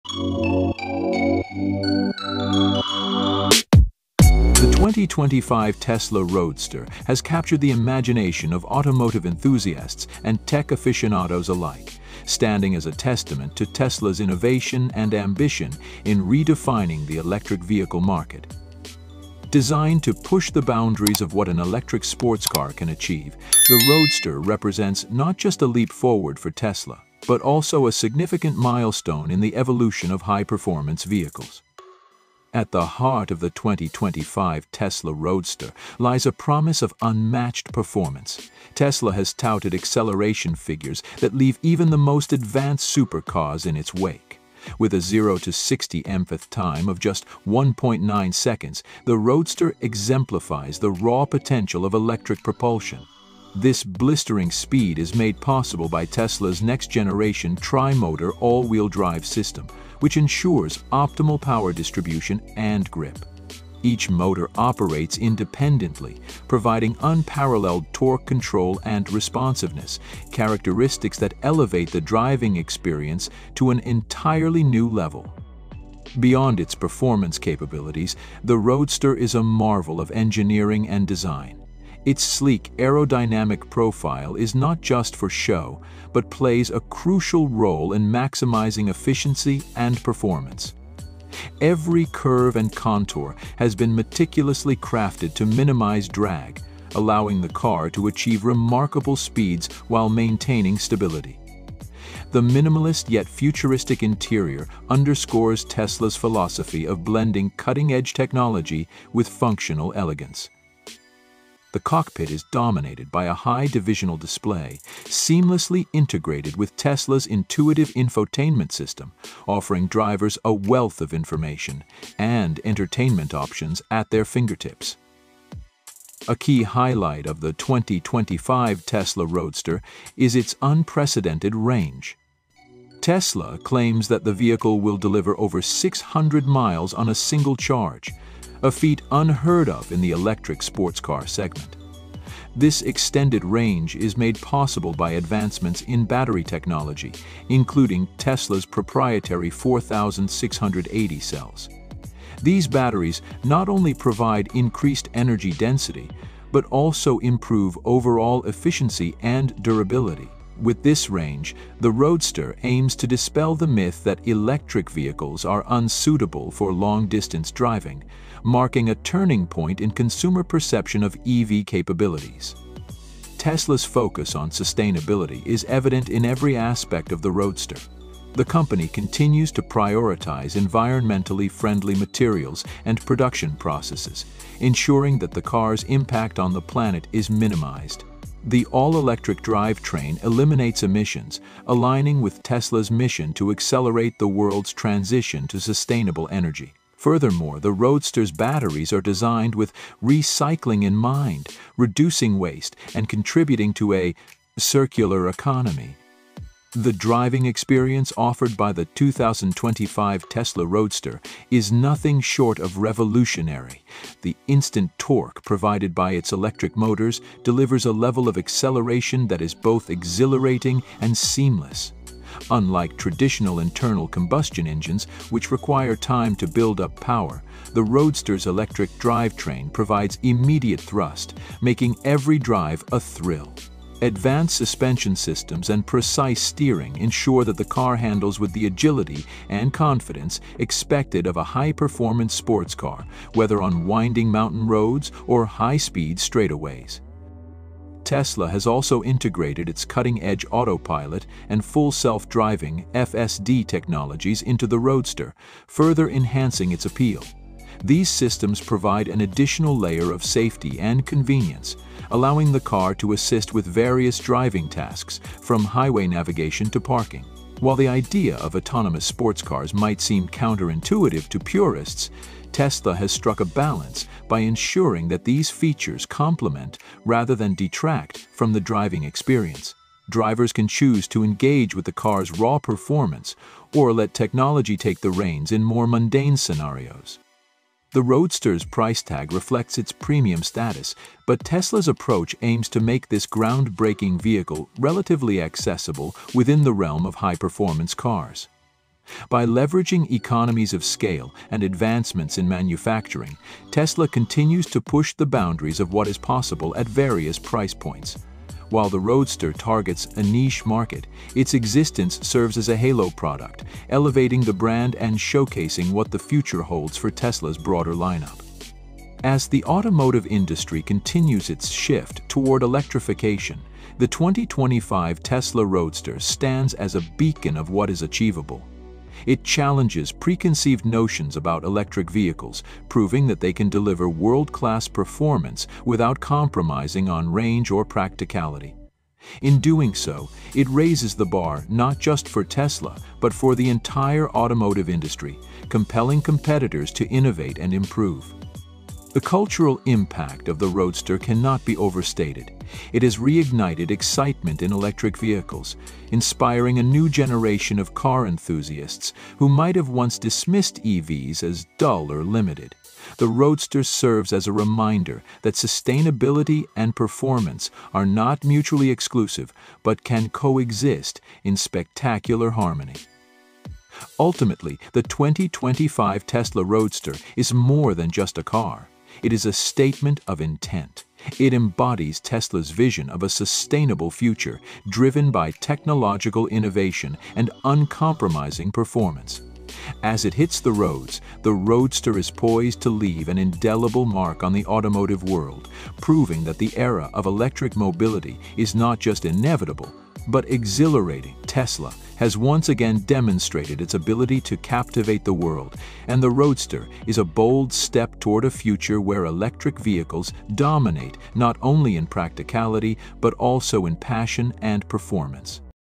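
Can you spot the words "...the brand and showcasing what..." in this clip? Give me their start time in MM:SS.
05:14.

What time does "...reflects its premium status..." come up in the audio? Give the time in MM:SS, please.
04:49.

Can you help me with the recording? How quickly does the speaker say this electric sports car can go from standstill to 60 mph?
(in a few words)
1.9 seconds.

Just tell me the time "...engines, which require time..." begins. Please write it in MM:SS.
03:44.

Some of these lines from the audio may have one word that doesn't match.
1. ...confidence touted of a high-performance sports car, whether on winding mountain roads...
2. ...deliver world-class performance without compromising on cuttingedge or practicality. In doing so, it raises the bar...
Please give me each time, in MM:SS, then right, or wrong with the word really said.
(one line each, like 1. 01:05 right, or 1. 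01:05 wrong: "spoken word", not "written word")
1. 03:59 wrong: "expected", not "touted"
2. 05:33 wrong: "range", not "cuttingedge".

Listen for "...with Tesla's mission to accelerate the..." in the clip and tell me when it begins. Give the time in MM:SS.
03:12.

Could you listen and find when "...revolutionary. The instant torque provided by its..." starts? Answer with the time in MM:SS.
03:32.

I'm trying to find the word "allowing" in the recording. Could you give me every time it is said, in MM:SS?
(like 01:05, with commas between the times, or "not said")
01:36, 04:22.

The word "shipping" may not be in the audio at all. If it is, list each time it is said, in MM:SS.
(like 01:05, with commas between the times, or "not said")
not said.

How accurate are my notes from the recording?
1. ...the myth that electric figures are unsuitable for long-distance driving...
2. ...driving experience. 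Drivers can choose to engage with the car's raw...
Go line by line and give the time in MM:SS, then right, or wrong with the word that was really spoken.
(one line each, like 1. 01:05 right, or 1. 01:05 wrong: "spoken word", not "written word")
1. 02:43 wrong: "vehicles", not "figures"
2. 04:38 right.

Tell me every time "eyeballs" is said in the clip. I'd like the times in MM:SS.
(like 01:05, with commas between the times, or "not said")
not said.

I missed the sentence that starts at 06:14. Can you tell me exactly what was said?
Ultimately, the 2025 Tesla Roadster is more than just a car.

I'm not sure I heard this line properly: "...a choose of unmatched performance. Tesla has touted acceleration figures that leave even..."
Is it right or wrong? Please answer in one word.
wrong.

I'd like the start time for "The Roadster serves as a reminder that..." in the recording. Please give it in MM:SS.
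06:03.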